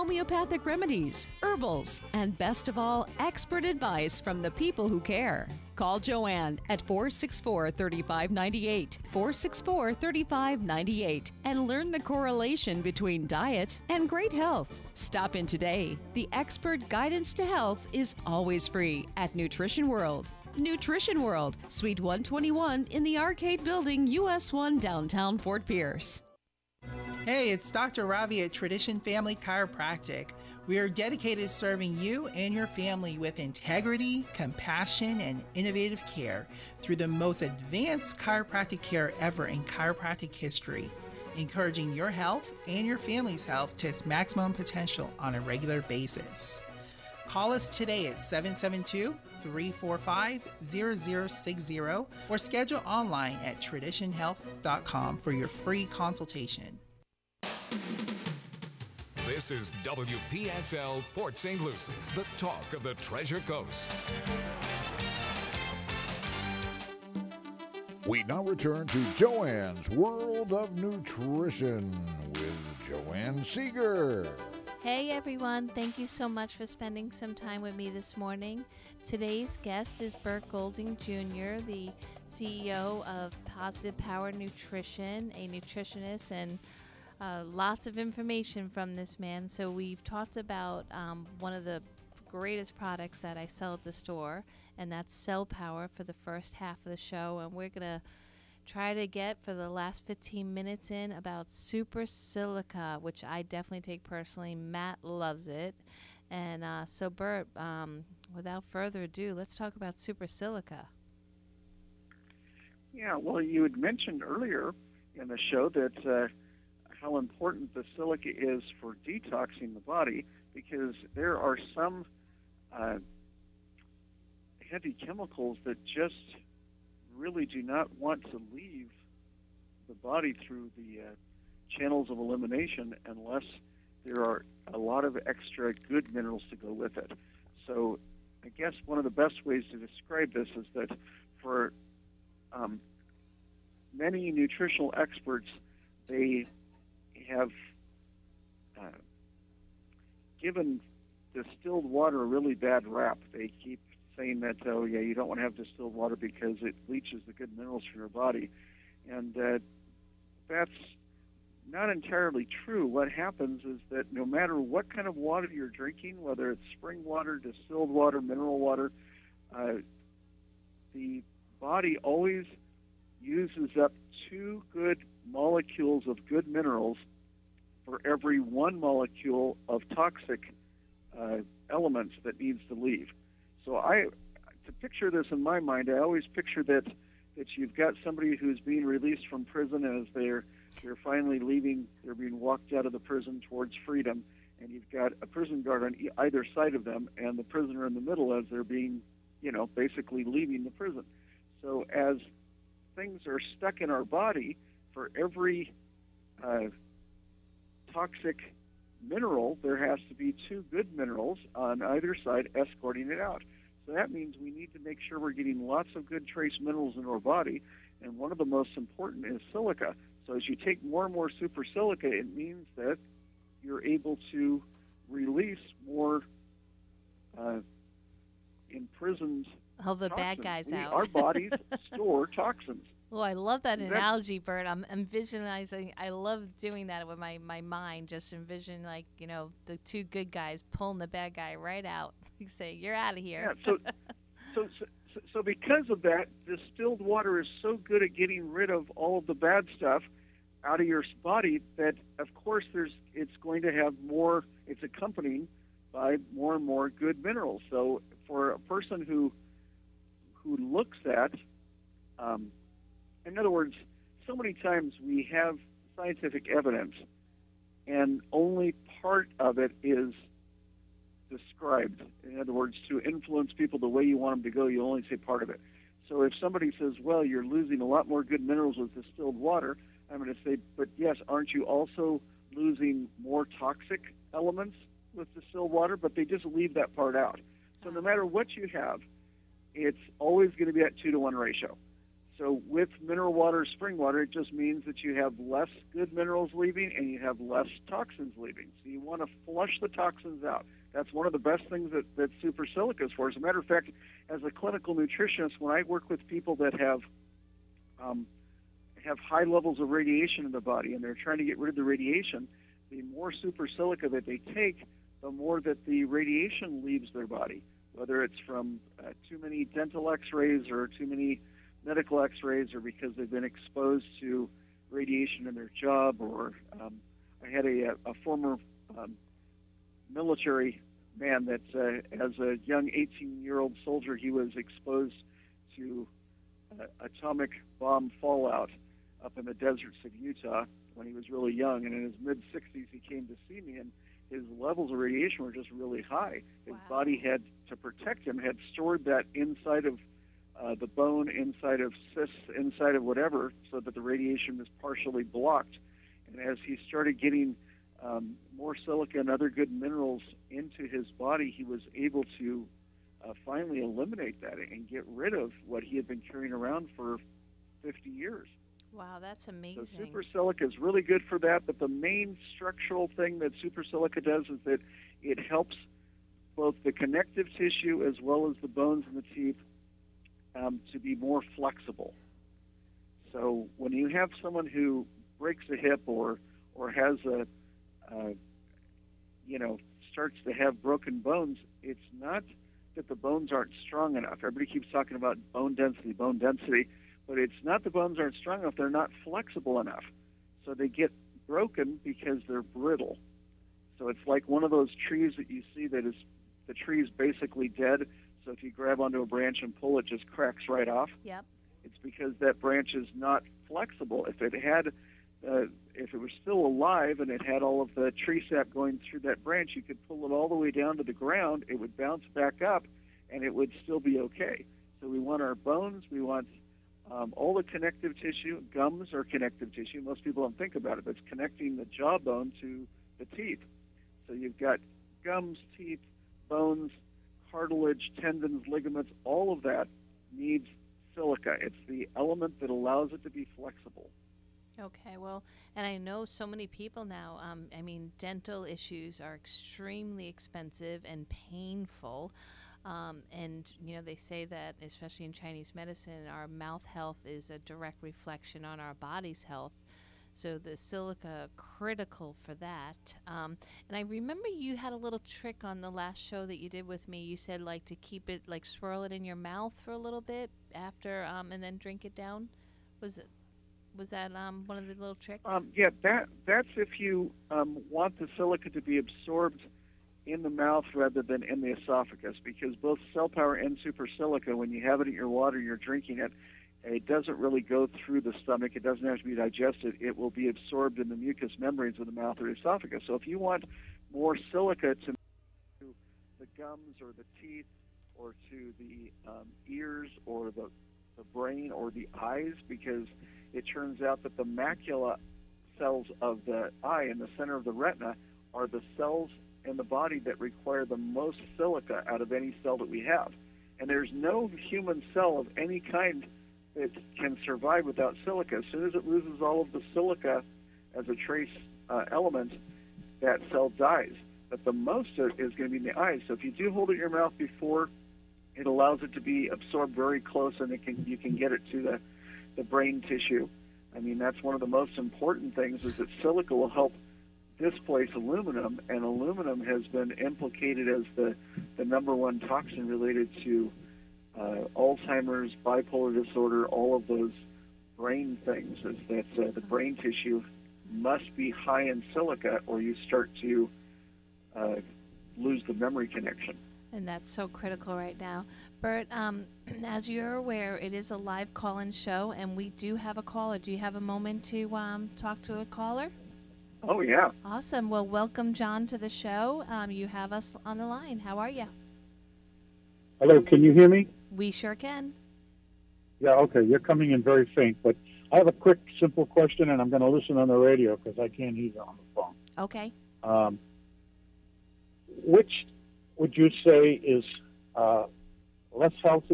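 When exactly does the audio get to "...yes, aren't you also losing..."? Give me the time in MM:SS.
04:40.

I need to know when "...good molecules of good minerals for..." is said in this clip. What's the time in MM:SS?
02:54.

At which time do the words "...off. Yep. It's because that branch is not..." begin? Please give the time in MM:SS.
06:50.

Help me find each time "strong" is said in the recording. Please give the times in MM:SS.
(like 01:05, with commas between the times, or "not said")
06:33, 06:38.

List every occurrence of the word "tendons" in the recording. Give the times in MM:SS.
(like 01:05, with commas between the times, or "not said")
07:18.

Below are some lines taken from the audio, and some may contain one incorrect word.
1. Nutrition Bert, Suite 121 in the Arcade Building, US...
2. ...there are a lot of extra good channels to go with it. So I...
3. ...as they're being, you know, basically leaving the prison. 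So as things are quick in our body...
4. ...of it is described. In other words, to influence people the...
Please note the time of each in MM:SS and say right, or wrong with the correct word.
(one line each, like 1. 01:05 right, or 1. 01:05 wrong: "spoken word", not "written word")
1. 00:20 wrong: "World", not "Bert"
2. 02:14 wrong: "minerals", not "channels"
3. 03:18 wrong: "stuck", not "quick"
4. 04:29 right.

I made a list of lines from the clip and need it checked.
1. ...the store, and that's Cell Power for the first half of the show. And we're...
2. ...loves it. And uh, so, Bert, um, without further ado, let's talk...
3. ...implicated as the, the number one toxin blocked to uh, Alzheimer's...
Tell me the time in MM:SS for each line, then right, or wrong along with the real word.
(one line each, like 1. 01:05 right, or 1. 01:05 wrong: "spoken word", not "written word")
1. 01:33 right
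2. 01:45 right
3. 09:00 wrong: "related", not "blocked".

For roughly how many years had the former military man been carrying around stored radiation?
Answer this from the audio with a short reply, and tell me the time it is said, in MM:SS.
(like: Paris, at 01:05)
50, at 06:07.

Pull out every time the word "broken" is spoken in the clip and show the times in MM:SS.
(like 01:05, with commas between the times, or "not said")
06:30, 06:41.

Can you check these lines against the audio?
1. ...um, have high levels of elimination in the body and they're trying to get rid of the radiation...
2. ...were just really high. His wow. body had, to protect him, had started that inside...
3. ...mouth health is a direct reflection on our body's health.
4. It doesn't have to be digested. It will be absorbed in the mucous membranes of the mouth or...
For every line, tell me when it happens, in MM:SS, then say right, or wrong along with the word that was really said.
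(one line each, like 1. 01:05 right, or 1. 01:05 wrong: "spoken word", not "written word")
1. 05:07 wrong: "radiation", not "elimination"
2. 05:45 wrong: "stored", not "started"
3. 07:36 right
4. 08:08 right.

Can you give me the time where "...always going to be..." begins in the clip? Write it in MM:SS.
04:50.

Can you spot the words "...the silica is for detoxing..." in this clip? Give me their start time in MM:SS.
01:57.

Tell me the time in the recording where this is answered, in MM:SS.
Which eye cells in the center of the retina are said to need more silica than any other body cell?
08:24.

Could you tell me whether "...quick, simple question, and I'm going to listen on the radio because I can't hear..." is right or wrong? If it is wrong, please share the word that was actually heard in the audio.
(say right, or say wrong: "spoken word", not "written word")
right.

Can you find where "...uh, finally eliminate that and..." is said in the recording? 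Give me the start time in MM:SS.
06:03.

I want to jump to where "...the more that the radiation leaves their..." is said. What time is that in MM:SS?
05:15.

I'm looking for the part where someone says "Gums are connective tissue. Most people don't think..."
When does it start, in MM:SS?
07:08.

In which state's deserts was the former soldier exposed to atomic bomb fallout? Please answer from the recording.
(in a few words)
Utah.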